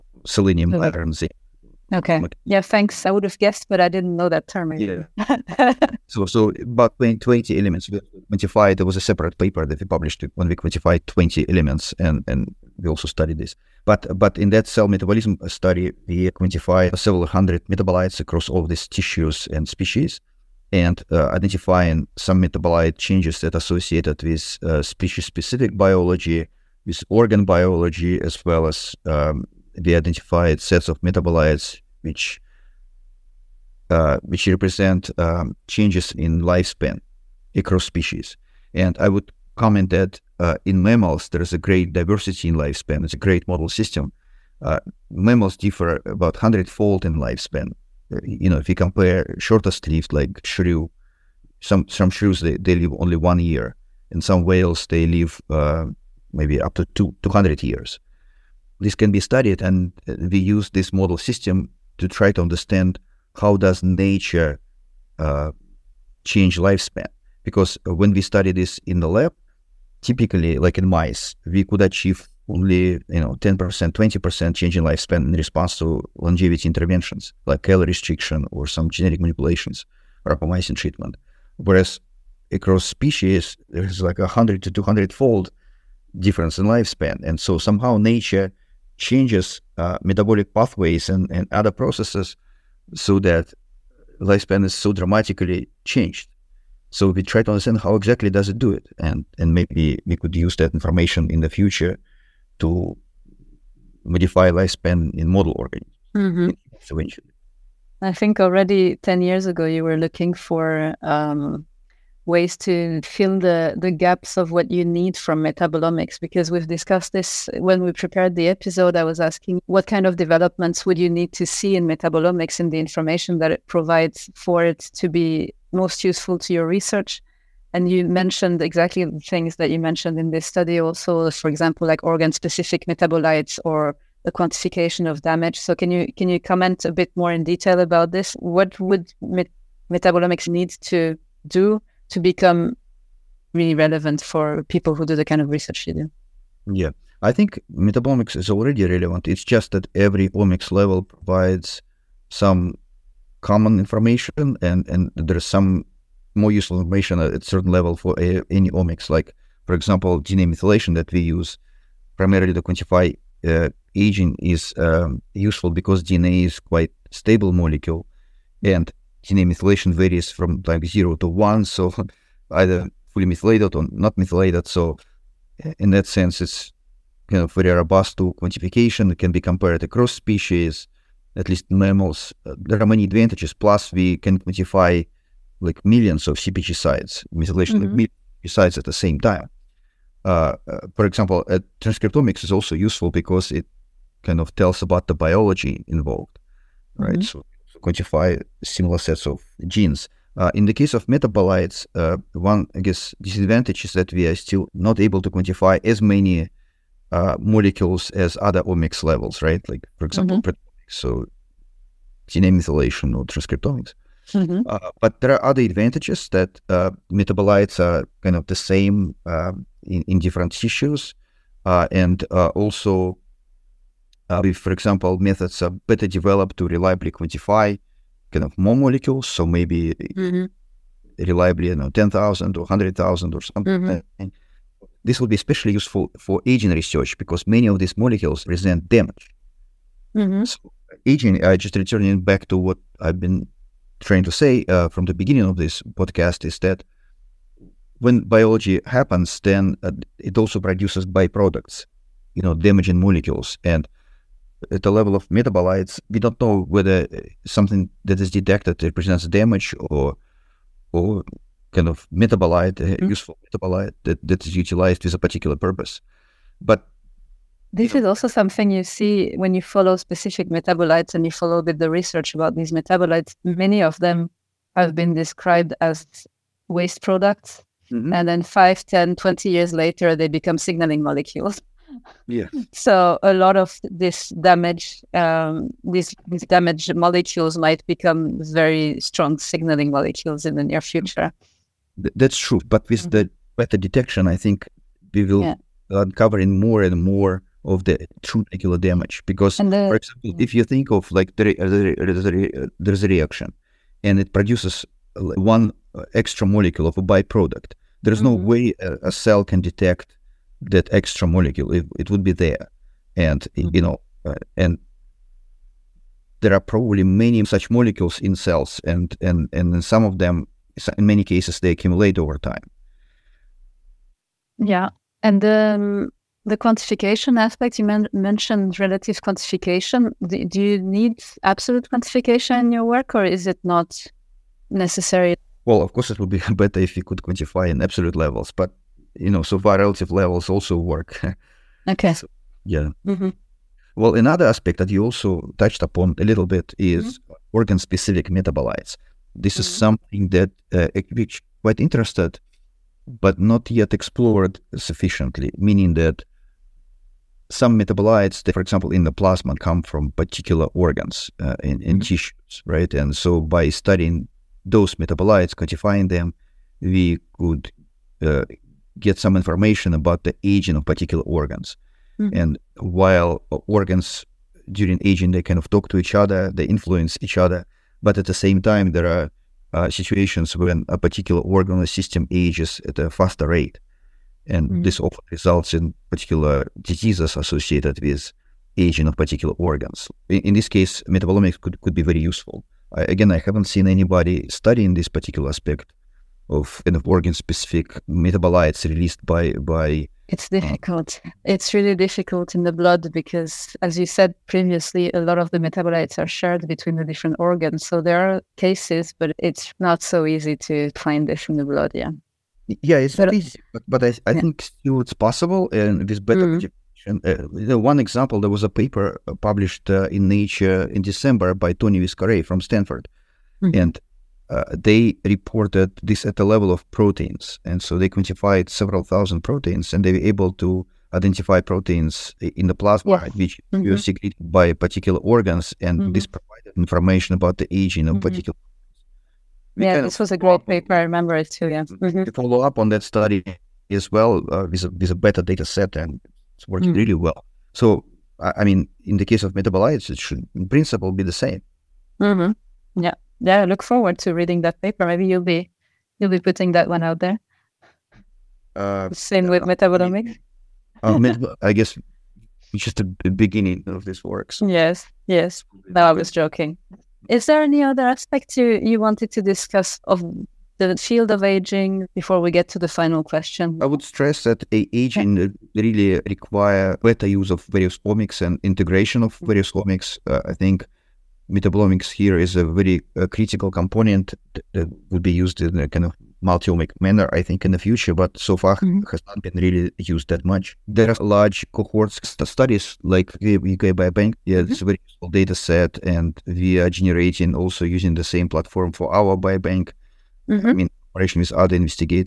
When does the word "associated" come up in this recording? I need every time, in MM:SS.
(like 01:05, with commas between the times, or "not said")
00:23, 06:27.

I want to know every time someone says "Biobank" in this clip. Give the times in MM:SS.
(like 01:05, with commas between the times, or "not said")
08:13, 08:19.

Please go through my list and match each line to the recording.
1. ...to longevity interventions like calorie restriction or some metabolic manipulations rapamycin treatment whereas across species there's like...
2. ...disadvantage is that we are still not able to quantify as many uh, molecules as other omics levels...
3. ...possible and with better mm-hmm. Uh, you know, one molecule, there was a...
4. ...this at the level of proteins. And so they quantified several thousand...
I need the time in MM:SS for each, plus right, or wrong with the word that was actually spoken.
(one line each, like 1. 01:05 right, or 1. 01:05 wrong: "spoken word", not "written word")
1. 01:15 wrong: "genetic", not "metabolic"
2. 03:23 right
3. 06:55 wrong: "example", not "molecule"
4. 07:06 right.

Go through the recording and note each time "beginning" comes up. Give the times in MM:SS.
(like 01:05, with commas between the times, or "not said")
04:05, 07:43.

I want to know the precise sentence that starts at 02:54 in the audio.
So eh, in that sense, it's kind of very robust to quantification.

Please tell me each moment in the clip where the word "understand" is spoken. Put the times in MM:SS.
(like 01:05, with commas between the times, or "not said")
01:02, 01:37.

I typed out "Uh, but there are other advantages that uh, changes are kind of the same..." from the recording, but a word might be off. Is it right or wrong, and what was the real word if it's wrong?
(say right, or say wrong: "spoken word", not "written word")
wrong: "metabolites", not "changes".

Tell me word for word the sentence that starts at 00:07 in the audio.
We quantified, there was a separate paper that we published when we quantified 20 elements, and, and we also studied this.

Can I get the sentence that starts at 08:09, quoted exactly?
has not been really used that much.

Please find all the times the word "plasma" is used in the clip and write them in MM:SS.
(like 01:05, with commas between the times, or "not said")
05:59, 07:12.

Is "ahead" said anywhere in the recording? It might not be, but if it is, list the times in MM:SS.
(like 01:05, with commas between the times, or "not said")
not said.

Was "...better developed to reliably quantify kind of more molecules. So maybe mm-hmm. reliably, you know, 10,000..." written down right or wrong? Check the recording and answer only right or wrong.
right.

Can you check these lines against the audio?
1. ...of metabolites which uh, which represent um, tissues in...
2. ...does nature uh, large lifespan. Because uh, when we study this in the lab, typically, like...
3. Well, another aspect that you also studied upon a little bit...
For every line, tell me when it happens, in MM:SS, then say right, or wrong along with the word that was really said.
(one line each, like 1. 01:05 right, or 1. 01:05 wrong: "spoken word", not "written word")
1. 00:30 wrong: "changes", not "tissues"
2. 01:03 wrong: "change", not "large"
3. 05:43 wrong: "touched", not "studied".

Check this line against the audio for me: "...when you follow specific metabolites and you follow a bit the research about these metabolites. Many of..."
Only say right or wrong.
right.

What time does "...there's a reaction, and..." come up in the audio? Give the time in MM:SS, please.
05:01.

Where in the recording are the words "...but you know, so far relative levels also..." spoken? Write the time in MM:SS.
05:38.